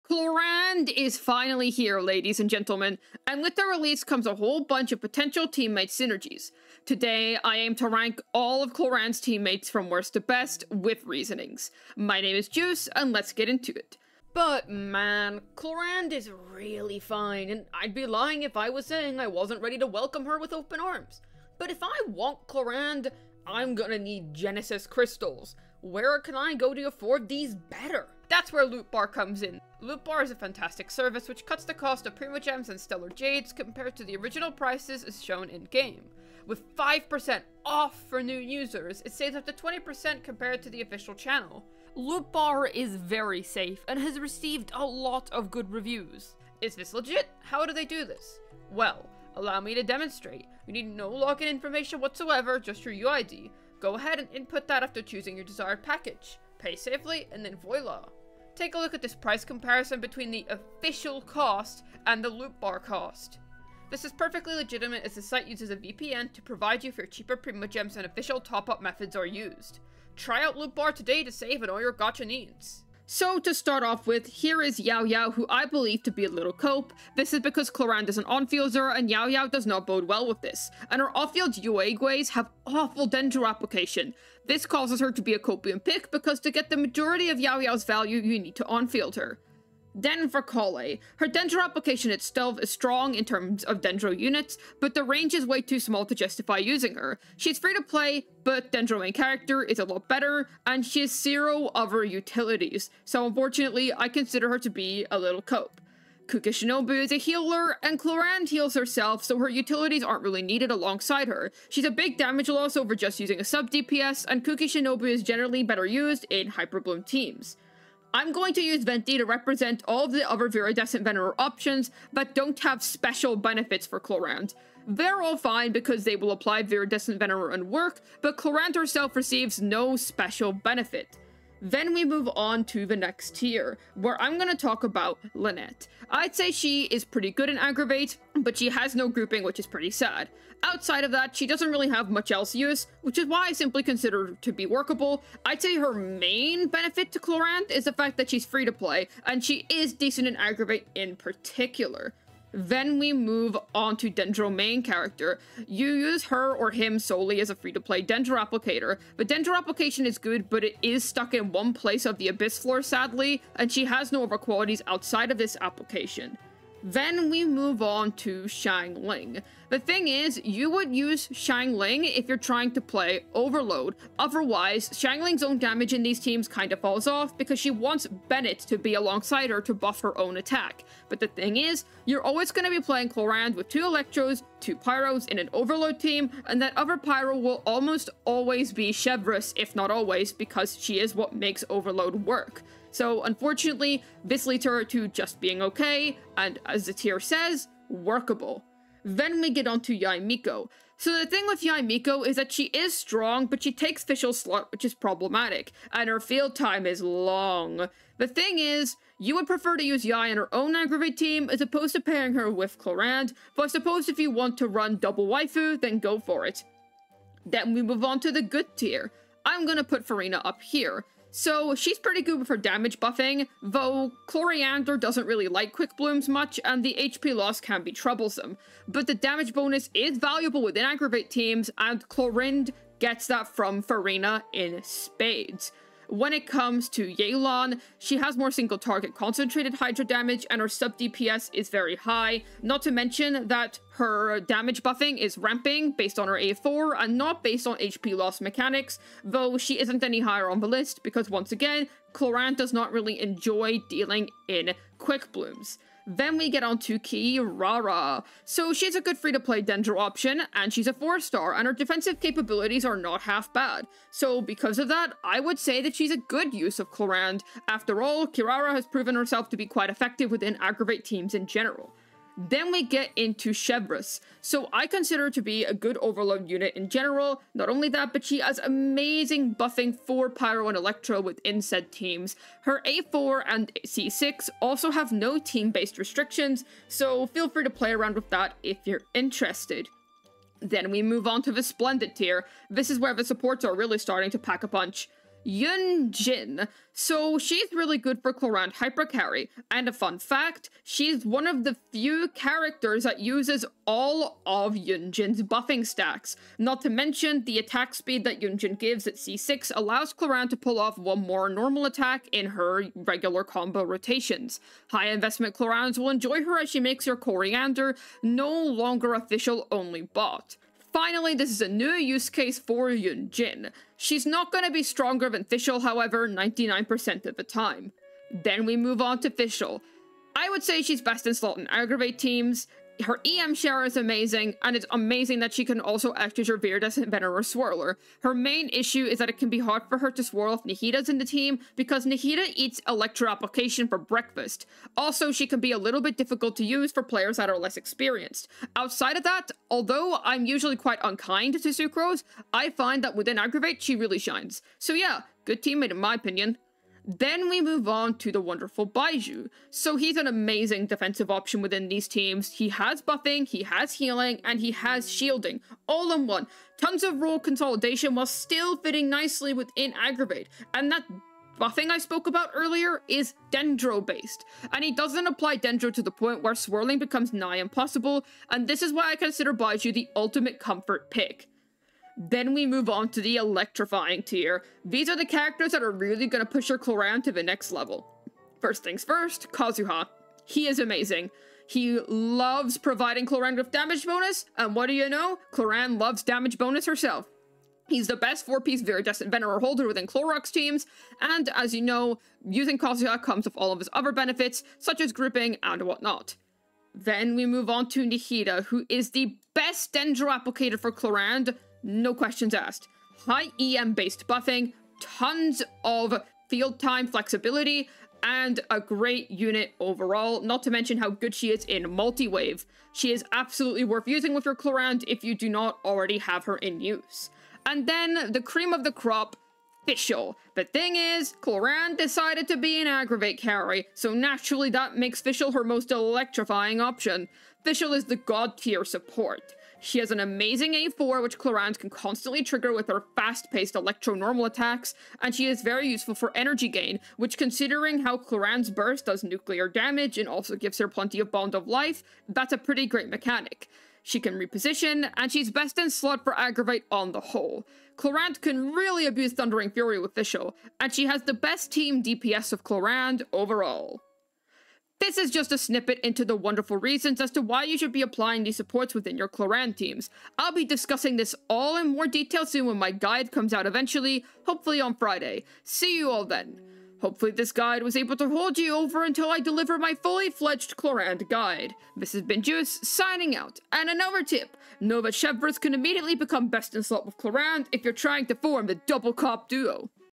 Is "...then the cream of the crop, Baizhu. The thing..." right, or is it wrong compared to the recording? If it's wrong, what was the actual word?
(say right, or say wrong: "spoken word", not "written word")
wrong: "Fischl", not "Baizhu".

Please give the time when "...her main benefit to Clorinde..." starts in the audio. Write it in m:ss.
2:25.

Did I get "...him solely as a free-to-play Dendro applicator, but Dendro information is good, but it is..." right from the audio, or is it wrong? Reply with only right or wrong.
wrong.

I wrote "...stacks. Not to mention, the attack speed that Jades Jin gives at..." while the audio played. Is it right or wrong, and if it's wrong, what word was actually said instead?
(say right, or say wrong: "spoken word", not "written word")
wrong: "Yun", not "Jades".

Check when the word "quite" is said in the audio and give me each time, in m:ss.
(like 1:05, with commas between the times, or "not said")
4:29, 5:50.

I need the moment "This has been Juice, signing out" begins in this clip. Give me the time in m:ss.
8:01.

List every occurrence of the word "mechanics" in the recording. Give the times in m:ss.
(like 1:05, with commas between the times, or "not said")
4:08, 7:33.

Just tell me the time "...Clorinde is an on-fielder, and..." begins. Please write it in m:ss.
1:17.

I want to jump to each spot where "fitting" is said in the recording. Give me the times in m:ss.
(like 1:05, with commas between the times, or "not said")
6:08.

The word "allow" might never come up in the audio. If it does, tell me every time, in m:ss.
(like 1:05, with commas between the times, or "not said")
0:49, 5:09.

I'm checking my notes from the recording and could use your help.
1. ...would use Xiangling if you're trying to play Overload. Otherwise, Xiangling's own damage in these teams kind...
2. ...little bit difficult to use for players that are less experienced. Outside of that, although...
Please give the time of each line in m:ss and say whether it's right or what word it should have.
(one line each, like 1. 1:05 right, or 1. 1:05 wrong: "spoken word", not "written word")
1. 2:50 right
2. 5:45 right.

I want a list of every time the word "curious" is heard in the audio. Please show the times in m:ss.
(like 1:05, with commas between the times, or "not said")
not said.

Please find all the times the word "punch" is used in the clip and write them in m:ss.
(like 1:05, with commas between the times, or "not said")
4:54.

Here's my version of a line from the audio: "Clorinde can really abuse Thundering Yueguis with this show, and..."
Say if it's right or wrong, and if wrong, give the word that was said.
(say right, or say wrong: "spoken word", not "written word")
wrong: "Fury", not "Yueguis".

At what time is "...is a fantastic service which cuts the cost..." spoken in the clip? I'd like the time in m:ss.
0:30.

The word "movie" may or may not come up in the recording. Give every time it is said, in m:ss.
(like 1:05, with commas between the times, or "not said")
not said.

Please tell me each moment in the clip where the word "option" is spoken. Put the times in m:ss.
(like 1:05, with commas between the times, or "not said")
2:01, 4:19, 6:01, 7:16.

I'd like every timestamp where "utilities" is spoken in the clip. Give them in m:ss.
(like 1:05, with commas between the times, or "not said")
1:42, 1:49.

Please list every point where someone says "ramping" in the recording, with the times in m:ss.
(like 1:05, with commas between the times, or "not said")
4:05.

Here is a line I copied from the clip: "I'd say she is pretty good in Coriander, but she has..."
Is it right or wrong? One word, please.
wrong.